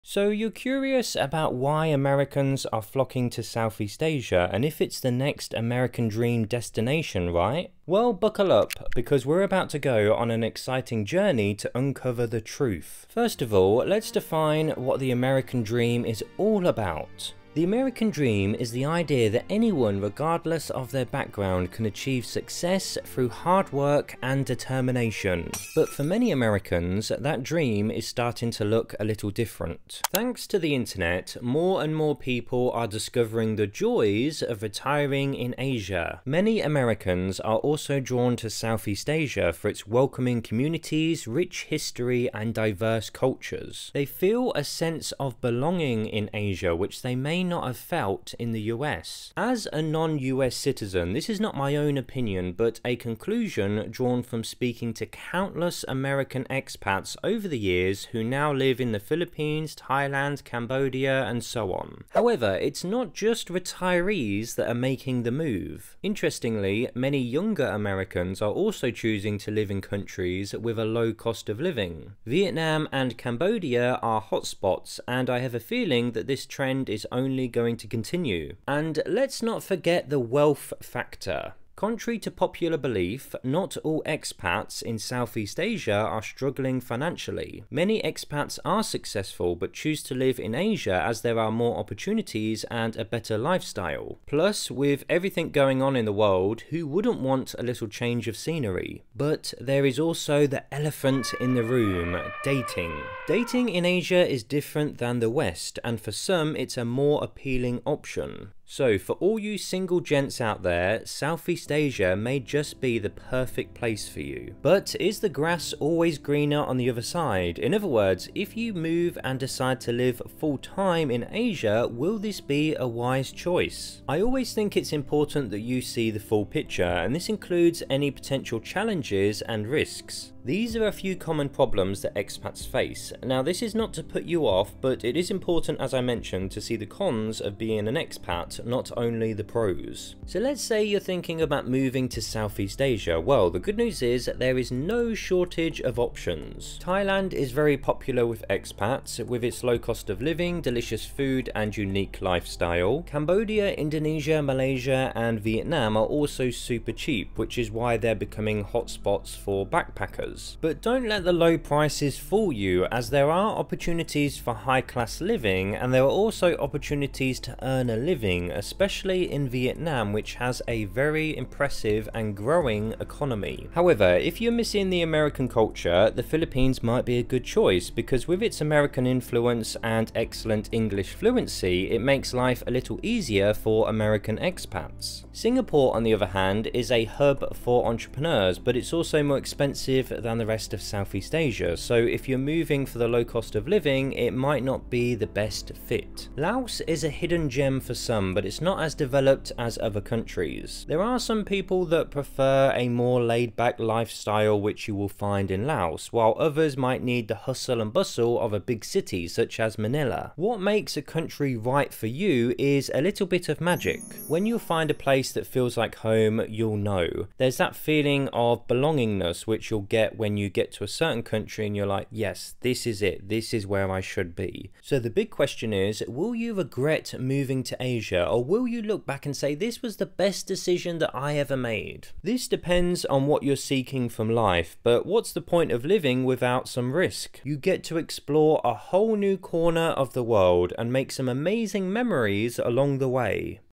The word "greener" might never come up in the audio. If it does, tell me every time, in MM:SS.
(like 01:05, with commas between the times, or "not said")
01:56.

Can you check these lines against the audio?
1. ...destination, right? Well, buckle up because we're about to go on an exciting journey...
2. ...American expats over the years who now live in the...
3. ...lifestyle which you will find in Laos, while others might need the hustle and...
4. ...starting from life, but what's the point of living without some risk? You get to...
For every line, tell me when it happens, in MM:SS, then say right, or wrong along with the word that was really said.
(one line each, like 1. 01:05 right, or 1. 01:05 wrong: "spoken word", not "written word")
1. 00:06 right
2. 00:55 right
3. 03:23 right
4. 03:53 wrong: "seeking", not "starting".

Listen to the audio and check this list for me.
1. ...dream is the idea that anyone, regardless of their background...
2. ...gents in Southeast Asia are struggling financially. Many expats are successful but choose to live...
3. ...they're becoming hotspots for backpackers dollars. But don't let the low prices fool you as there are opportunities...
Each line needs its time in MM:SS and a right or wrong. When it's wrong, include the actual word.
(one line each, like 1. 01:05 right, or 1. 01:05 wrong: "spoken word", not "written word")
1. 00:18 right
2. 01:24 wrong: "expats", not "gents"
3. 02:37 right.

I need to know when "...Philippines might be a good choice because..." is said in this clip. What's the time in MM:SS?
02:56.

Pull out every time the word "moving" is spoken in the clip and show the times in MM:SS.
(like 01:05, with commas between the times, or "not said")
02:21, 03:12, 03:47.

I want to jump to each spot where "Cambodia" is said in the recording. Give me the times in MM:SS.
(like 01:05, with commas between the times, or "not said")
01:00, 01:13, 02:33.